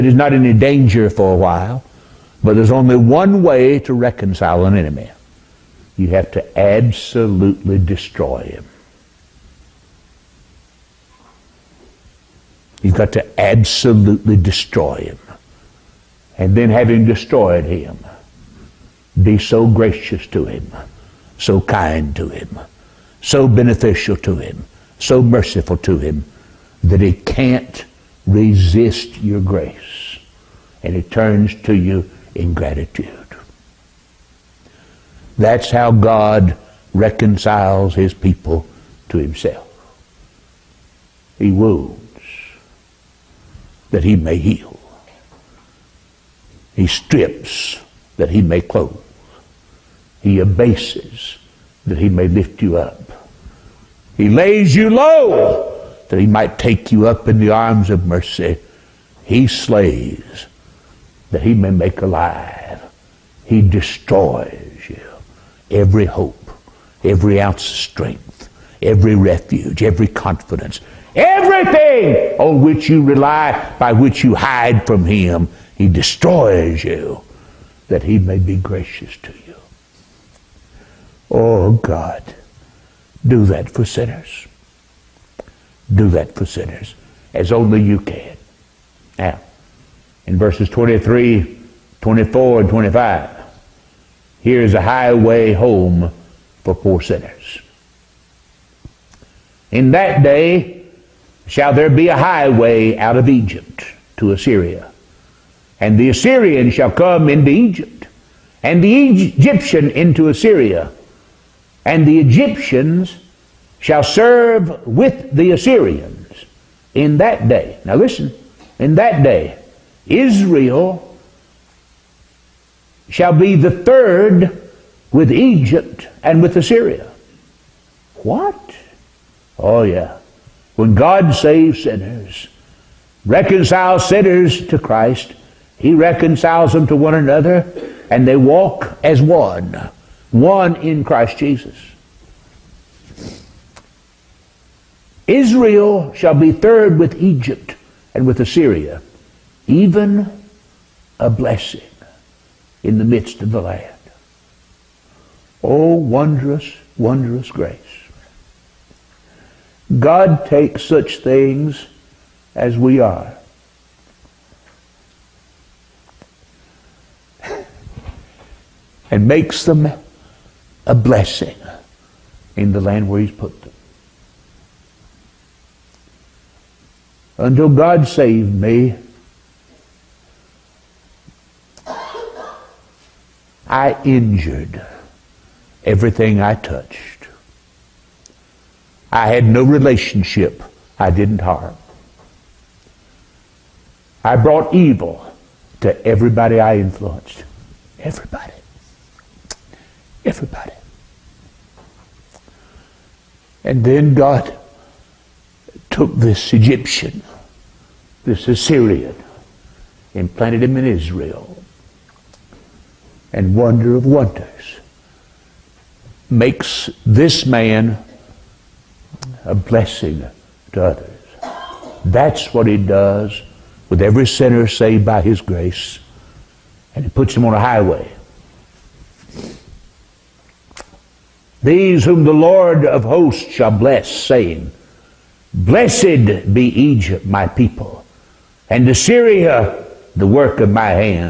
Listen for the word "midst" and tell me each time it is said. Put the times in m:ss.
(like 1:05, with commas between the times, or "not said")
2:33.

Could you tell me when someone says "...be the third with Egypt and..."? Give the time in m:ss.
2:03.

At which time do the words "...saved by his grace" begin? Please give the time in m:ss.
3:44.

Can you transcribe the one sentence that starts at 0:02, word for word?
But there's only one way to reconcile an enemy.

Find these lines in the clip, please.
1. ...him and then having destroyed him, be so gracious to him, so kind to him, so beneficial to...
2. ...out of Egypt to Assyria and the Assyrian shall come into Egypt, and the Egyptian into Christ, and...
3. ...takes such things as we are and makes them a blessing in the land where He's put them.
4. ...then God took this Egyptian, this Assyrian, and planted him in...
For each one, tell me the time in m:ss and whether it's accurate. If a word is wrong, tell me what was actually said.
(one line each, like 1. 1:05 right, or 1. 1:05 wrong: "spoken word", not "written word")
1. 0:14 right
2. 1:42 wrong: "Assyria", not "Christ"
3. 2:40 right
4. 3:23 right.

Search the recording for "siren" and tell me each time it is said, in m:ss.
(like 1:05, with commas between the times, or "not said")
not said.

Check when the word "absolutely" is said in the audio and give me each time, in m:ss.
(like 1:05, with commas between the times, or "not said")
0:06, 0:13.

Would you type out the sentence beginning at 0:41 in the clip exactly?
He wounds that he may heal.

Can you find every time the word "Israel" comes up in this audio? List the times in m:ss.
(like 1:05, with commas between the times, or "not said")
2:00, 2:25, 3:30.